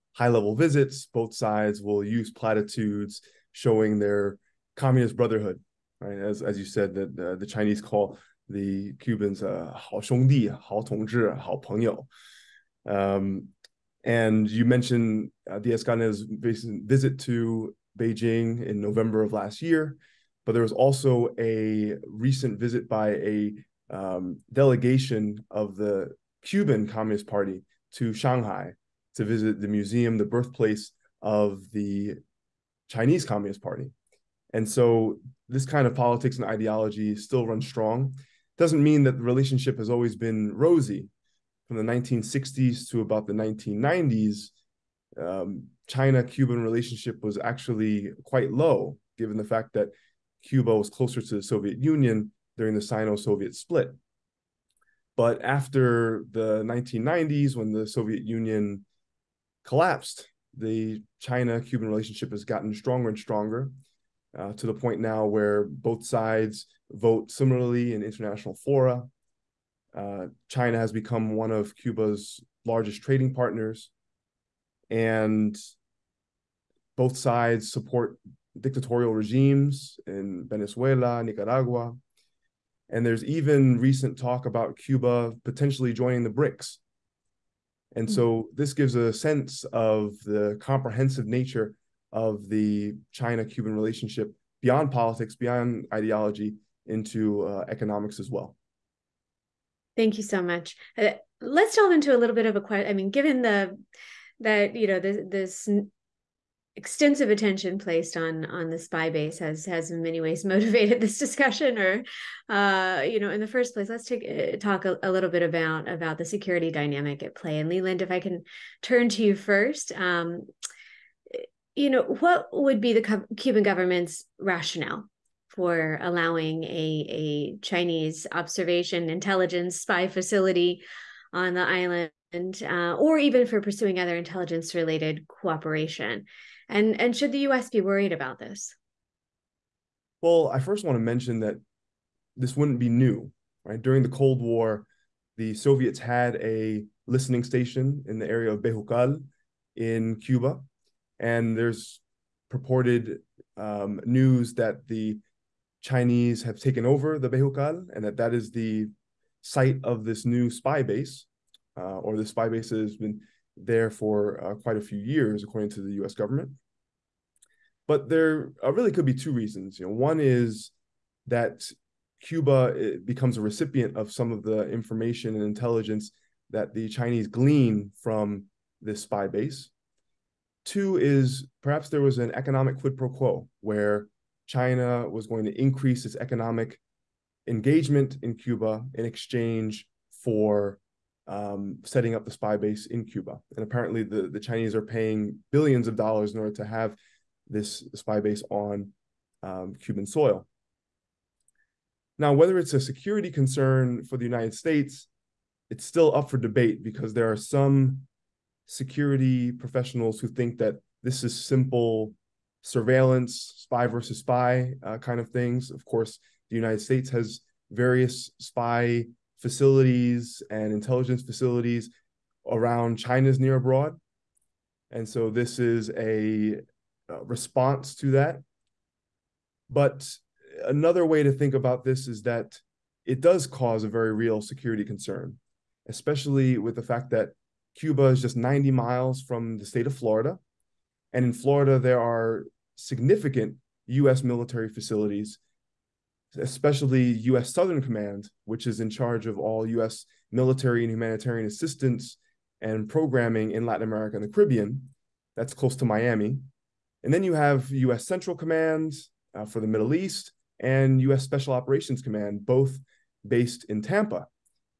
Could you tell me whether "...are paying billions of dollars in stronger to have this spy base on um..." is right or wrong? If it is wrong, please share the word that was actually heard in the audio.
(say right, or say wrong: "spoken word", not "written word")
wrong: "order", not "stronger".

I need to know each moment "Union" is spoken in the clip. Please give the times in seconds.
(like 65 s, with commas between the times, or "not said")
51 s, 58 s.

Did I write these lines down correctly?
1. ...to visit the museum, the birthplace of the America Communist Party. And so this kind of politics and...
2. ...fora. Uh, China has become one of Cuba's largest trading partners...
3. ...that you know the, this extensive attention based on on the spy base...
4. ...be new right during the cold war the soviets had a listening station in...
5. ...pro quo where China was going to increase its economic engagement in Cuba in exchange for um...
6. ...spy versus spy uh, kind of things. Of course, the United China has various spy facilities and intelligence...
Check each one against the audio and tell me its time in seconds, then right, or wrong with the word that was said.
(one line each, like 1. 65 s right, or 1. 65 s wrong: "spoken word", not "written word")
1. 29 s wrong: "Chinese", not "America"
2. 68 s right
3. 104 s wrong: "placed", not "based"
4. 142 s right
5. 182 s right
6. 213 s wrong: "States", not "China".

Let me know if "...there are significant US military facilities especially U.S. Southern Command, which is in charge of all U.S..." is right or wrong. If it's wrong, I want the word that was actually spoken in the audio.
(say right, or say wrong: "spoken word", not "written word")
right.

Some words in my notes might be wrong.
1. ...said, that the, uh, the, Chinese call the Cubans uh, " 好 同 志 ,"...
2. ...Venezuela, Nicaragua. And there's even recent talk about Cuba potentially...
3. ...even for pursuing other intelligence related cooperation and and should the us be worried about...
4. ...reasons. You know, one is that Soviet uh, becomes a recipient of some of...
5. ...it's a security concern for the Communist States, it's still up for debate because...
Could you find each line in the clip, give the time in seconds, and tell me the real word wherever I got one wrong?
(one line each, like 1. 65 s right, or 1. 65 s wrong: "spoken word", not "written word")
1. 6 s right
2. 80 s right
3. 133 s right
4. 169 s wrong: "Cuba", not "Soviet"
5. 202 s wrong: "United", not "Communist".